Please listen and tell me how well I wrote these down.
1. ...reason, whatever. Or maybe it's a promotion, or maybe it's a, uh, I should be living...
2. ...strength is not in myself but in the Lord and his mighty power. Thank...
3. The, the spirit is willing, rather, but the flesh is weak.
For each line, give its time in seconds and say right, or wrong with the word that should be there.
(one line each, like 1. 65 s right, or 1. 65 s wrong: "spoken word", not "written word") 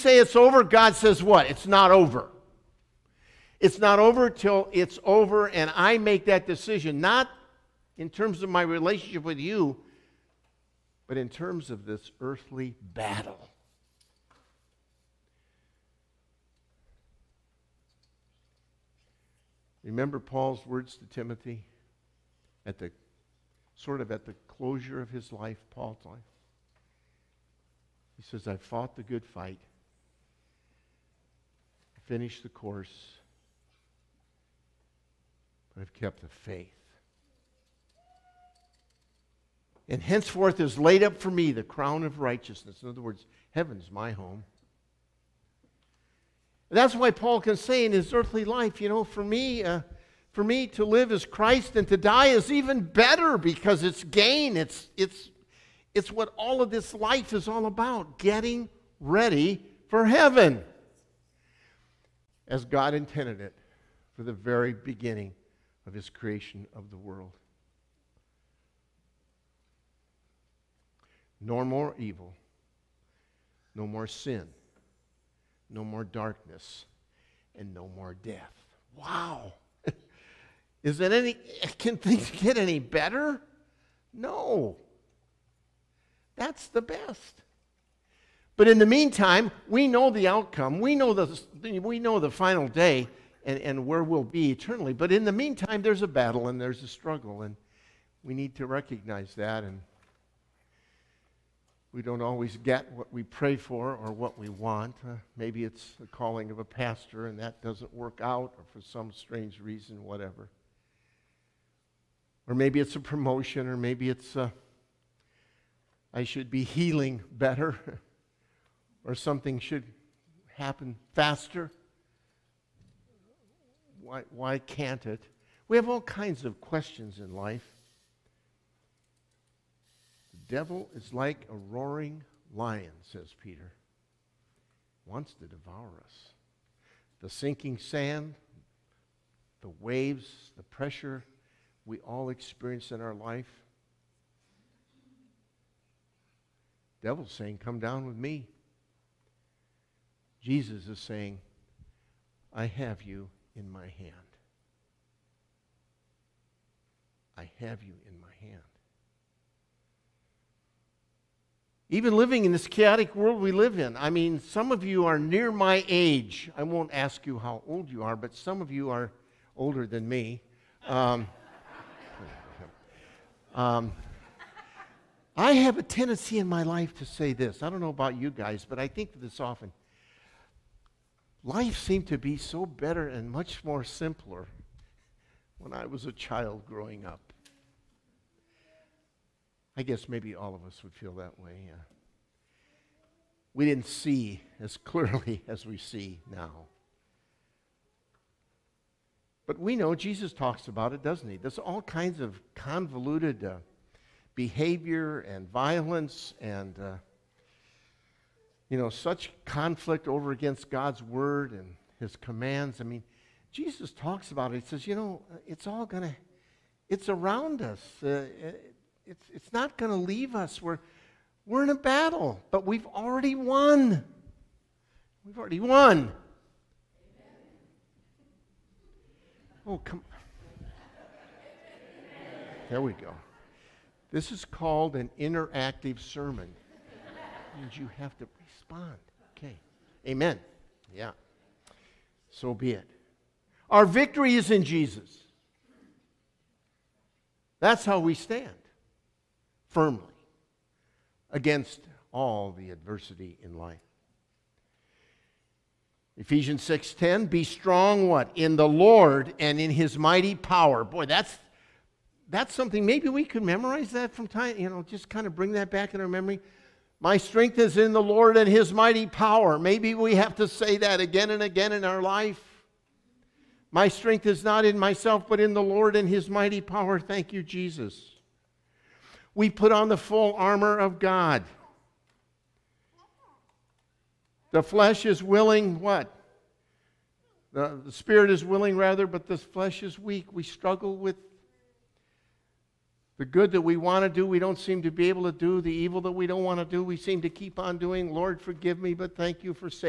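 1. 109 s wrong: "healing", not "living"
2. 273 s right
3. 287 s right.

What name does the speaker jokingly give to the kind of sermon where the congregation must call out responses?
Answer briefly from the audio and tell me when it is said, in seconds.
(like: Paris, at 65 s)
interactive sermon, at 235 s.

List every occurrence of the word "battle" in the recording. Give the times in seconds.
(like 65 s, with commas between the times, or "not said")
12 s, 96 s, 221 s.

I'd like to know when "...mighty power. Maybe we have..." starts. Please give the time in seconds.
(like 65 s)
268 s.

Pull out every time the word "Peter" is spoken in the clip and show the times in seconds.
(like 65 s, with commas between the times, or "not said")
133 s.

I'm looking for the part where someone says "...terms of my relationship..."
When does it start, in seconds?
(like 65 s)
8 s.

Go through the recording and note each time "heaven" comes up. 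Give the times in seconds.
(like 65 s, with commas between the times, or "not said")
43 s, 60 s.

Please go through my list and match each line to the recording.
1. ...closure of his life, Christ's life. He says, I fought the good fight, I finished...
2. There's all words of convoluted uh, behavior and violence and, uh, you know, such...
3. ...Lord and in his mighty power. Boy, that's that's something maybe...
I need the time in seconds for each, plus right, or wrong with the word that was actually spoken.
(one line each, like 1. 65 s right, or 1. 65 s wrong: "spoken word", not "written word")
1. 24 s wrong: "Paul", not "Christ"
2. 201 s wrong: "kinds", not "words"
3. 258 s right.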